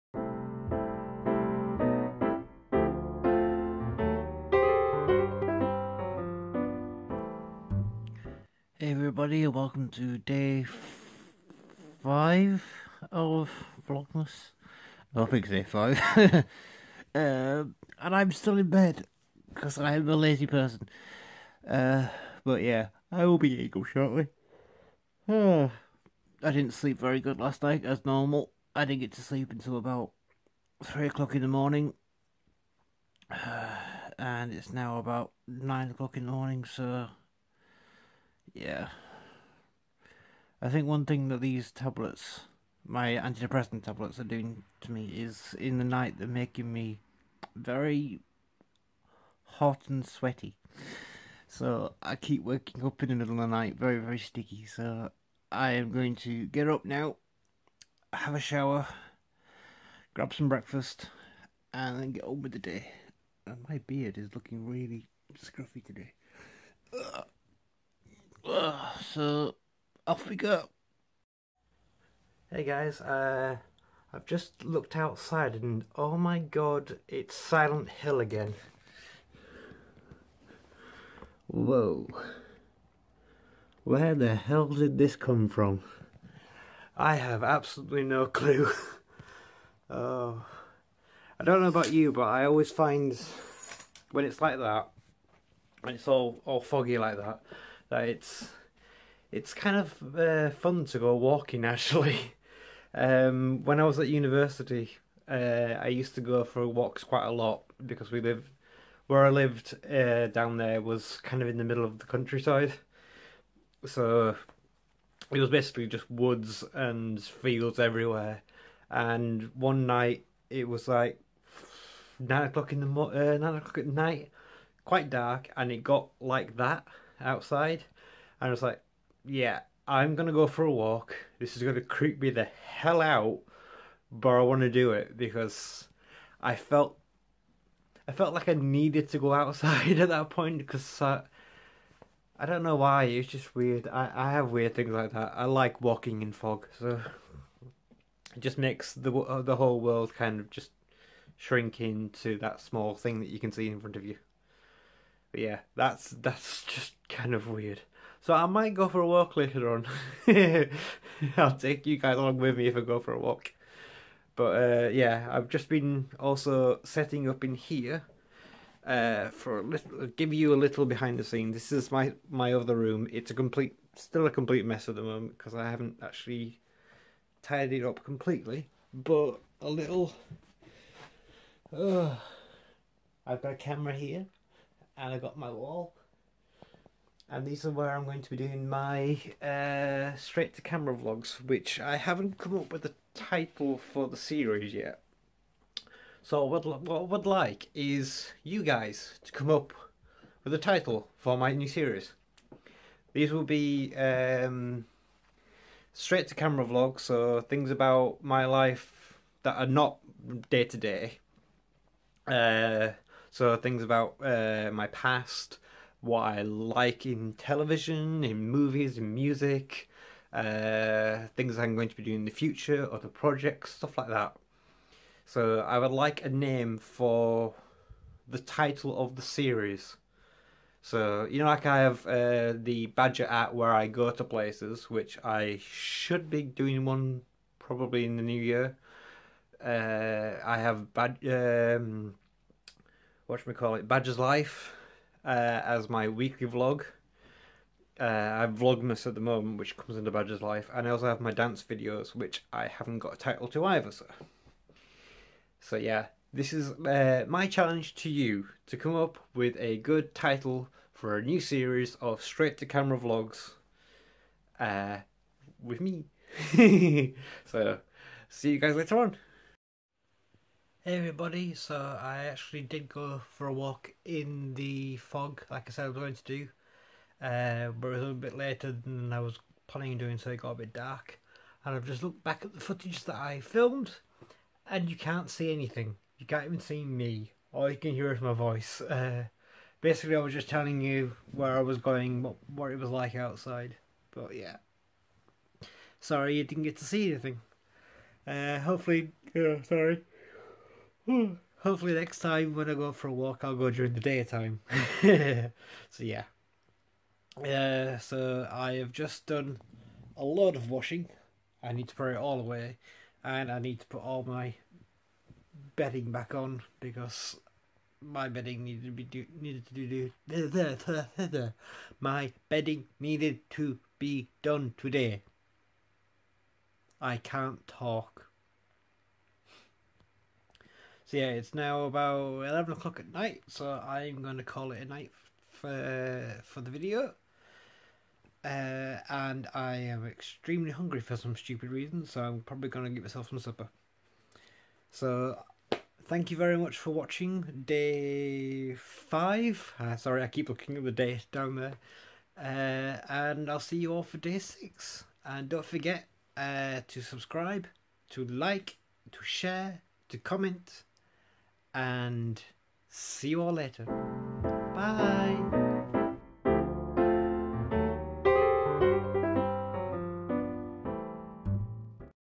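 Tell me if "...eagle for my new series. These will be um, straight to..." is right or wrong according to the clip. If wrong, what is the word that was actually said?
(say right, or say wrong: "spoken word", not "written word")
wrong: "title", not "eagle".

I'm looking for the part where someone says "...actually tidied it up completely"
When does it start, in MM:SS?
02:56.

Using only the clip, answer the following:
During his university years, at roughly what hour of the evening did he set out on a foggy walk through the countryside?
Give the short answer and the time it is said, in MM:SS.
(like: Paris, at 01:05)
9 o'clock at night, at 02:03.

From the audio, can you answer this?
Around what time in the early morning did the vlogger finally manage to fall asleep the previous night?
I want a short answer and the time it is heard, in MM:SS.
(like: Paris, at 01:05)
3 o'clock, at 00:30.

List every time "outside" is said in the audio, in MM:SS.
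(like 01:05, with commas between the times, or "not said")
01:14, 02:07, 02:19, 04:53.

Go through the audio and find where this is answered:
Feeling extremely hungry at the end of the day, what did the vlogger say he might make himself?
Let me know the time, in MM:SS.
05:43.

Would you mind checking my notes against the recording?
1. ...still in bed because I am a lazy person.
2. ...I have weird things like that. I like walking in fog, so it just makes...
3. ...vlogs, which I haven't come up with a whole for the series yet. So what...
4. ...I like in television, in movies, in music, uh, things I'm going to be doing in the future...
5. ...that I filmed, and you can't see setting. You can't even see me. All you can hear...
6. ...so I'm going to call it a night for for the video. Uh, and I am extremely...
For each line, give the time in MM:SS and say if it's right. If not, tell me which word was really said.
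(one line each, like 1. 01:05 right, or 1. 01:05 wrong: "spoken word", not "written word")
1. 00:18 right
2. 02:24 right
3. 03:10 wrong: "title", not "whole"
4. 03:36 right
5. 04:43 wrong: "anything", not "setting"
6. 05:33 right.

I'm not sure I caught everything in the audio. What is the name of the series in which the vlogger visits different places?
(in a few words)
the Badger app.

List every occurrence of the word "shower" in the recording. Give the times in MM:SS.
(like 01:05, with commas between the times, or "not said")
00:58.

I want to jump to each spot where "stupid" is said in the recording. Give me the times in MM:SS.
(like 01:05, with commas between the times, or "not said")
05:41.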